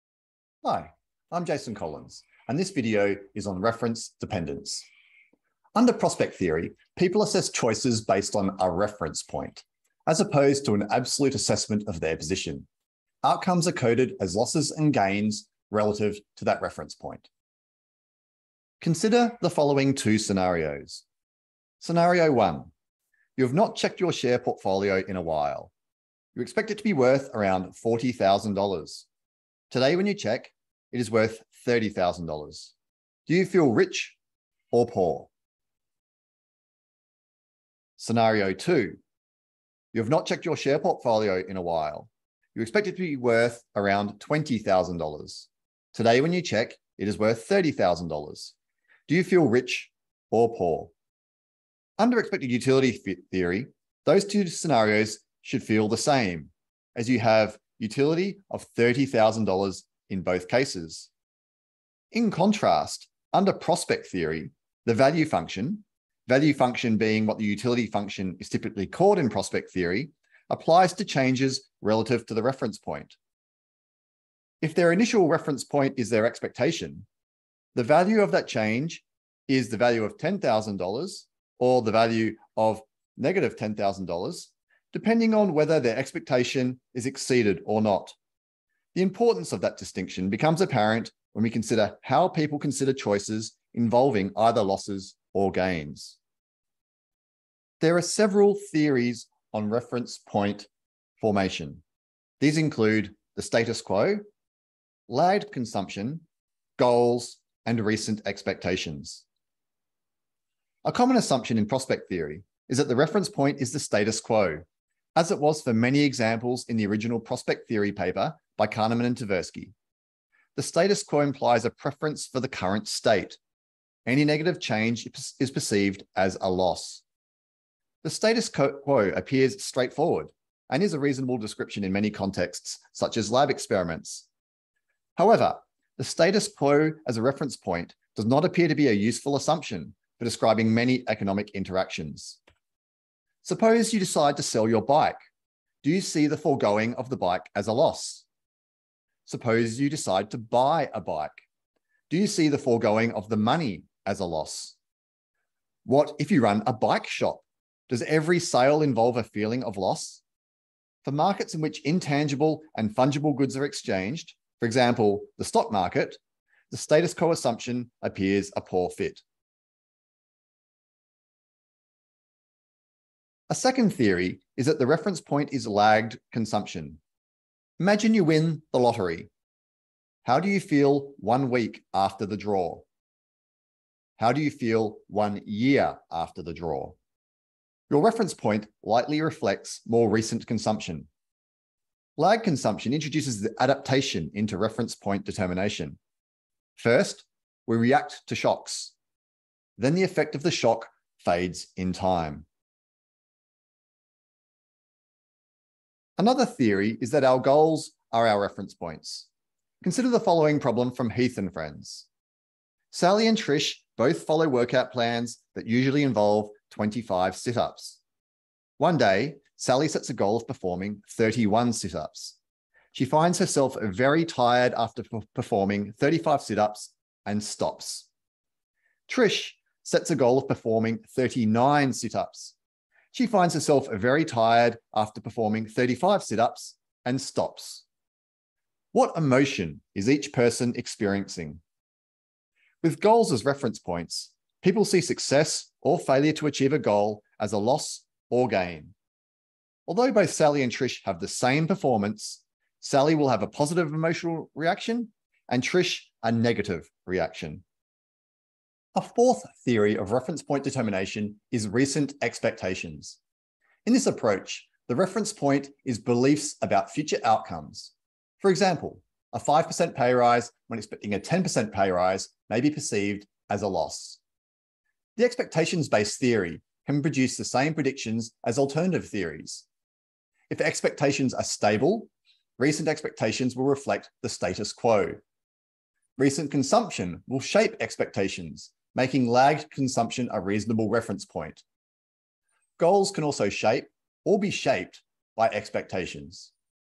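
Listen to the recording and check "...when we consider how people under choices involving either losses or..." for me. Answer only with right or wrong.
wrong.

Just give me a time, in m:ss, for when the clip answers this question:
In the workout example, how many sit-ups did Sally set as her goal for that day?
3:41.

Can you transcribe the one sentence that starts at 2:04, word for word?
Any negative change is perceived as a loss.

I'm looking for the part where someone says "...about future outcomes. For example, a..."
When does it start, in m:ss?
4:26.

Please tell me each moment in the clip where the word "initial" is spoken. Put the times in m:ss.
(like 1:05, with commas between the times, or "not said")
1:14.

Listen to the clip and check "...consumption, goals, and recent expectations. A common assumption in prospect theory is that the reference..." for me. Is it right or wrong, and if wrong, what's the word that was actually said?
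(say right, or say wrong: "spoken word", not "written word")
right.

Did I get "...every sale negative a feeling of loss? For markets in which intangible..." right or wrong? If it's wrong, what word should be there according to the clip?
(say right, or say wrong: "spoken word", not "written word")
wrong: "involve", not "negative".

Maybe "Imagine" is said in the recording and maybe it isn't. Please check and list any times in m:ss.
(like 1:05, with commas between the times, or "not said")
2:57.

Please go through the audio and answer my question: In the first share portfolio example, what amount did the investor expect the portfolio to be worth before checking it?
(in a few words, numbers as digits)
$40,000.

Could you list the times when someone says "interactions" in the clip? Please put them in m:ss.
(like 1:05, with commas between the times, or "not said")
2:21.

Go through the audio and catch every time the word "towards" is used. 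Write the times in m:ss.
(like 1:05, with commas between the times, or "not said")
not said.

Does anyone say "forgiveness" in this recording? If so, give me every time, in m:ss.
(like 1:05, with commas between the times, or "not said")
not said.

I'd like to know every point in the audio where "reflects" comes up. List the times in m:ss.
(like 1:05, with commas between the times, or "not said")
3:09, 4:43.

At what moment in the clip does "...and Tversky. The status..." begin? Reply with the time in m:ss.
1:59.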